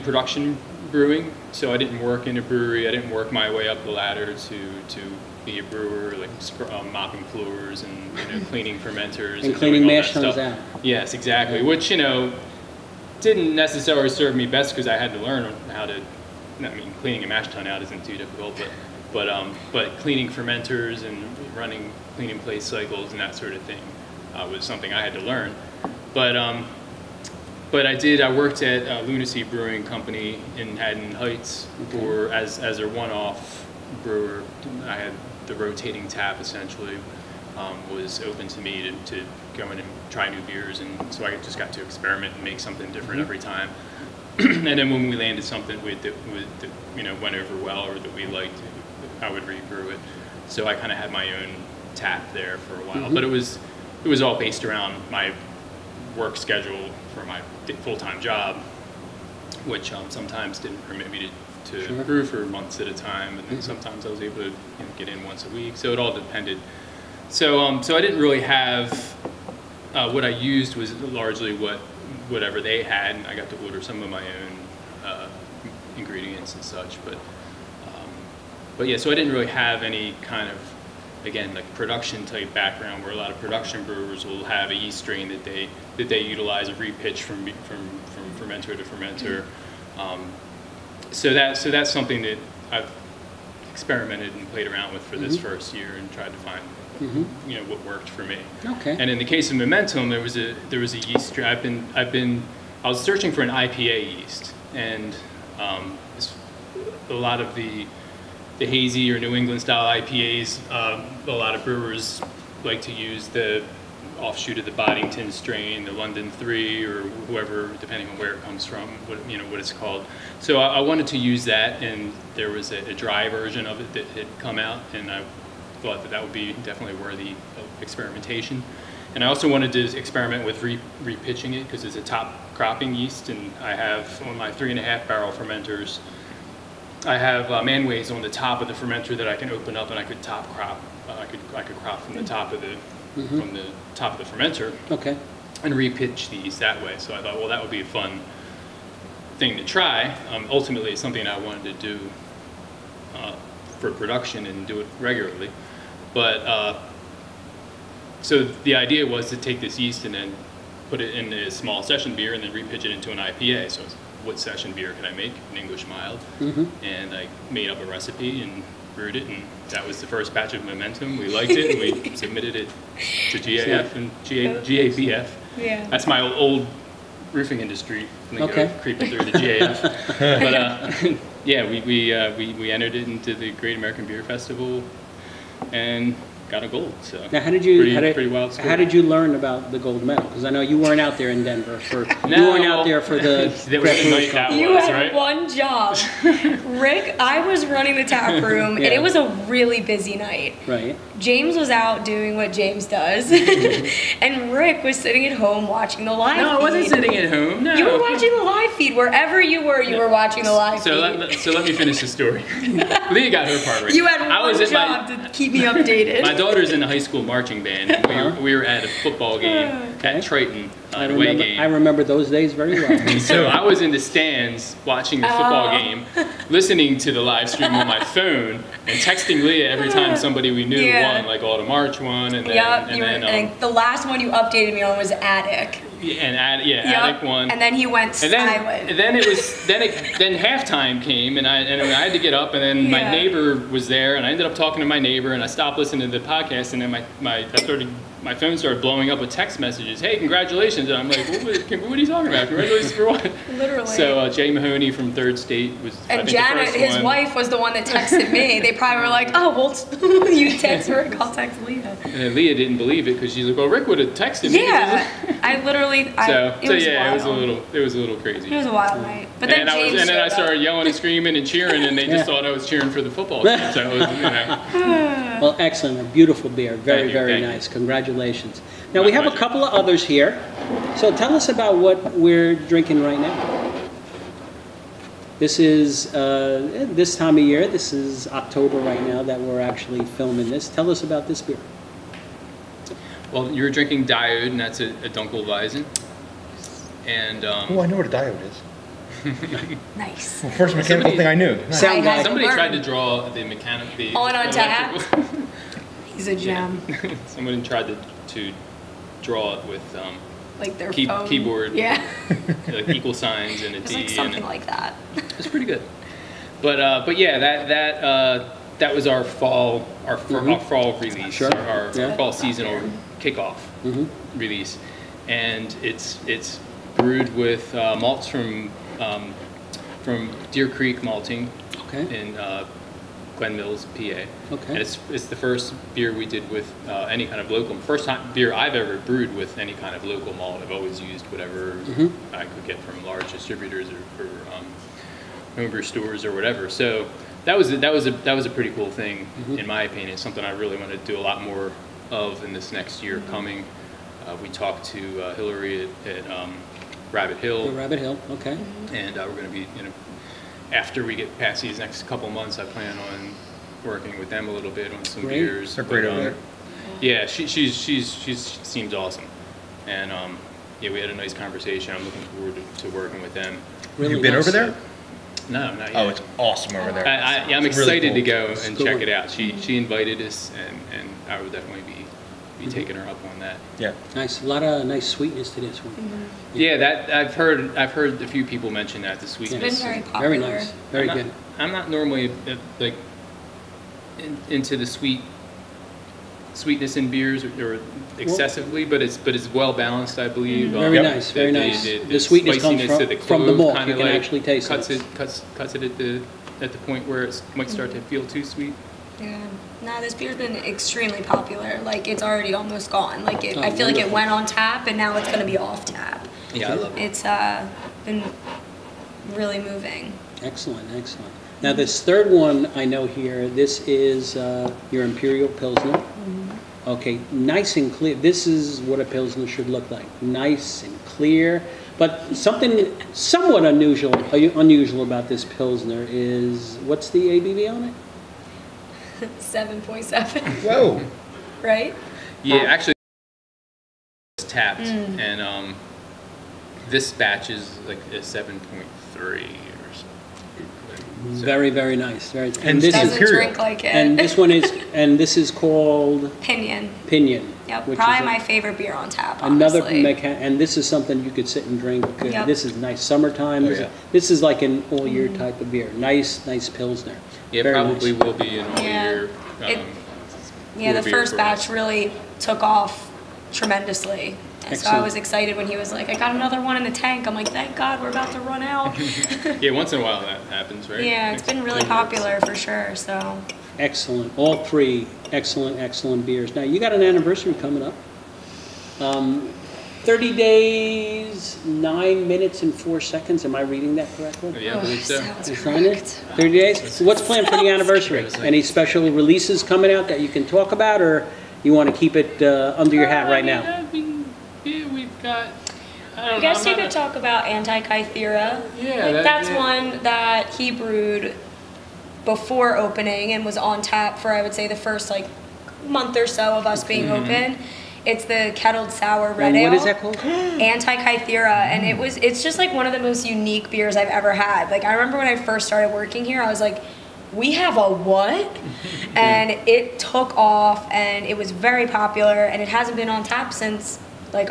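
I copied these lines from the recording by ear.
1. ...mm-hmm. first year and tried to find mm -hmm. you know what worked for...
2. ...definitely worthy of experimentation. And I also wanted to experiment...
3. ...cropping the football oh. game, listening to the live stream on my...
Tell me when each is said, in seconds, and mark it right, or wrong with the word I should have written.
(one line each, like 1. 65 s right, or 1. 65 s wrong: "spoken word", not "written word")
1. 95 s right
2. 126 s right
3. 224 s wrong: "watching", not "cropping".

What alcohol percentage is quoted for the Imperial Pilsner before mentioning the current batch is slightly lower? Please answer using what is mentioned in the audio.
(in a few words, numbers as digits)
7.7.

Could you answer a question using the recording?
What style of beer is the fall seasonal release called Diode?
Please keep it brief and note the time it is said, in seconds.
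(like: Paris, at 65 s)
Dunkelweizen, at 295 s.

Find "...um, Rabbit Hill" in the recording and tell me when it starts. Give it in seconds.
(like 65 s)
356 s.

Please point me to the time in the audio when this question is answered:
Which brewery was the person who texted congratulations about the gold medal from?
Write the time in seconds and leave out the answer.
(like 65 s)
255 s.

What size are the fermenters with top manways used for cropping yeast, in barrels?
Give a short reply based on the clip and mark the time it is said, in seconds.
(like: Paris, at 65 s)
3.5 barrels, at 134 s.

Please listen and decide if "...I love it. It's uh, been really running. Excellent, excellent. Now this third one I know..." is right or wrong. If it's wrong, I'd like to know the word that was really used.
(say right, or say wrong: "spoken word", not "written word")
wrong: "moving", not "running".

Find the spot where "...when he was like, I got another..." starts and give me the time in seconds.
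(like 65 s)
475 s.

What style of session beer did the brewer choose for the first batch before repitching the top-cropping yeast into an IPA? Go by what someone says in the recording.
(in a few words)
English mild.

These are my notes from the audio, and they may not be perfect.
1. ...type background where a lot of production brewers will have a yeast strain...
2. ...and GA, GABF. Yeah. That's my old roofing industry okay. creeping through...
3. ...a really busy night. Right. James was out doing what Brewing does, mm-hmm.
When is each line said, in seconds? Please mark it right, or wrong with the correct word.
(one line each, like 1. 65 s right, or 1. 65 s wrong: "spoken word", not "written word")
1. 82 s right
2. 173 s right
3. 199 s wrong: "James", not "Brewing".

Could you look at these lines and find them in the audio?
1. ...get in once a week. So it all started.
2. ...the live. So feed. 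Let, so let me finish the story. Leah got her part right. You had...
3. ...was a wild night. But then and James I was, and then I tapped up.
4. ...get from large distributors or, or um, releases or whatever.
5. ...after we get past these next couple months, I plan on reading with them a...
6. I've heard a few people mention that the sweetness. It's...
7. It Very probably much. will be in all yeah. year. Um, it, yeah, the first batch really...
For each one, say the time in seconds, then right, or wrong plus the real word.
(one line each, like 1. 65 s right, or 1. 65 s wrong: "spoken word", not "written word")
1. 64 s wrong: "depended", not "started"
2. 210 s right
3. 268 s wrong: "started", not "tapped"
4. 342 s wrong: "stores", not "releases"
5. 360 s wrong: "working", not "reading"
6. 387 s right
7. 467 s right.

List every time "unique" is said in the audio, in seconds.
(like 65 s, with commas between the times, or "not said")
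523 s.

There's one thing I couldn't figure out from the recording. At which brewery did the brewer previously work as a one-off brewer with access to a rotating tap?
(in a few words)
Lunacy Brewing Company.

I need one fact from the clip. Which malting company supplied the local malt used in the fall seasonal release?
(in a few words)
Deer Creek malting.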